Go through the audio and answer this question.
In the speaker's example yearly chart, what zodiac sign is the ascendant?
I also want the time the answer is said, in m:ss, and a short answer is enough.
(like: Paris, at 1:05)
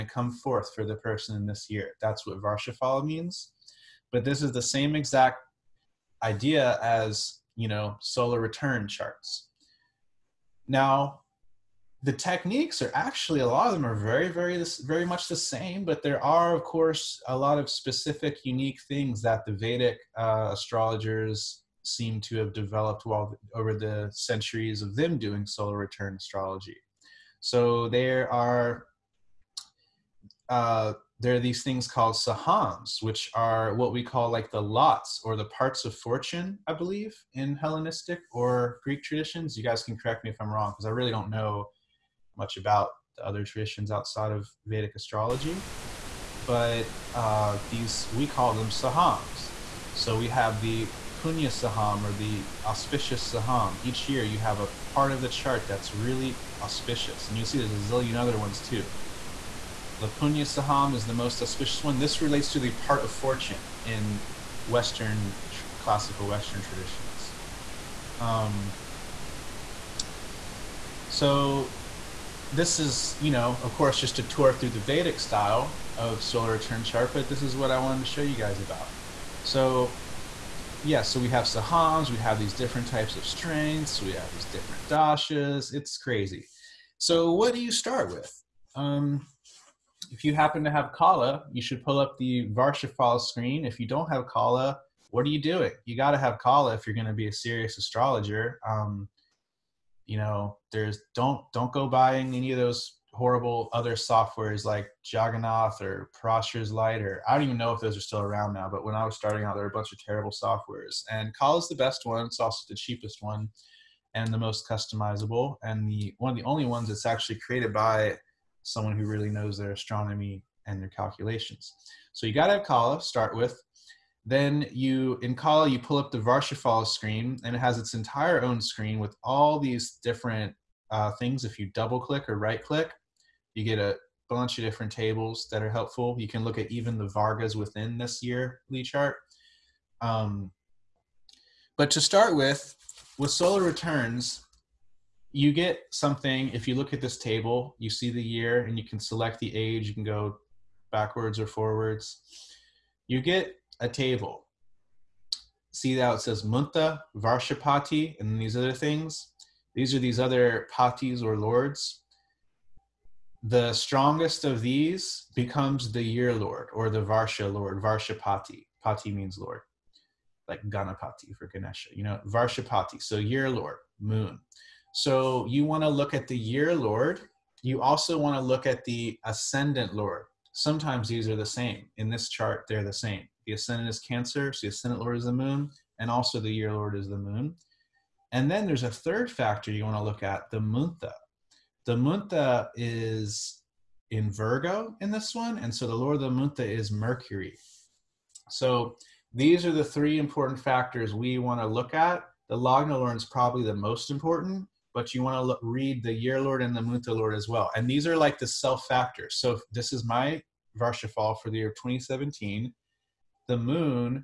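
Cancer, at 3:03.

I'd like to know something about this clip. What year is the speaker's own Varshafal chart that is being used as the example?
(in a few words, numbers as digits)
2017.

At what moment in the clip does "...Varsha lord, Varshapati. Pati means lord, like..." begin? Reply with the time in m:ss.
2:47.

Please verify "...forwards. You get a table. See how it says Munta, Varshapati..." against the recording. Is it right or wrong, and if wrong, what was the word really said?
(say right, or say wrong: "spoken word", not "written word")
right.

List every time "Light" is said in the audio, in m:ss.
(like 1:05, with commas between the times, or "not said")
1:46.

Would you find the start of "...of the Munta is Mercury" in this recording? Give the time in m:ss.
3:16.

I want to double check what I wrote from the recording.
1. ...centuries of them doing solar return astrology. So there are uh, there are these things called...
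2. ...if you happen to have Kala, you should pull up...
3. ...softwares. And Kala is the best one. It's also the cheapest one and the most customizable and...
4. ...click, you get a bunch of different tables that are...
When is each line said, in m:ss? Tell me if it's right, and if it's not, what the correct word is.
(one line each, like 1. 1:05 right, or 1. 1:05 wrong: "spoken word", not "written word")
1. 0:24 right
2. 1:30 right
3. 1:50 right
4. 2:12 right.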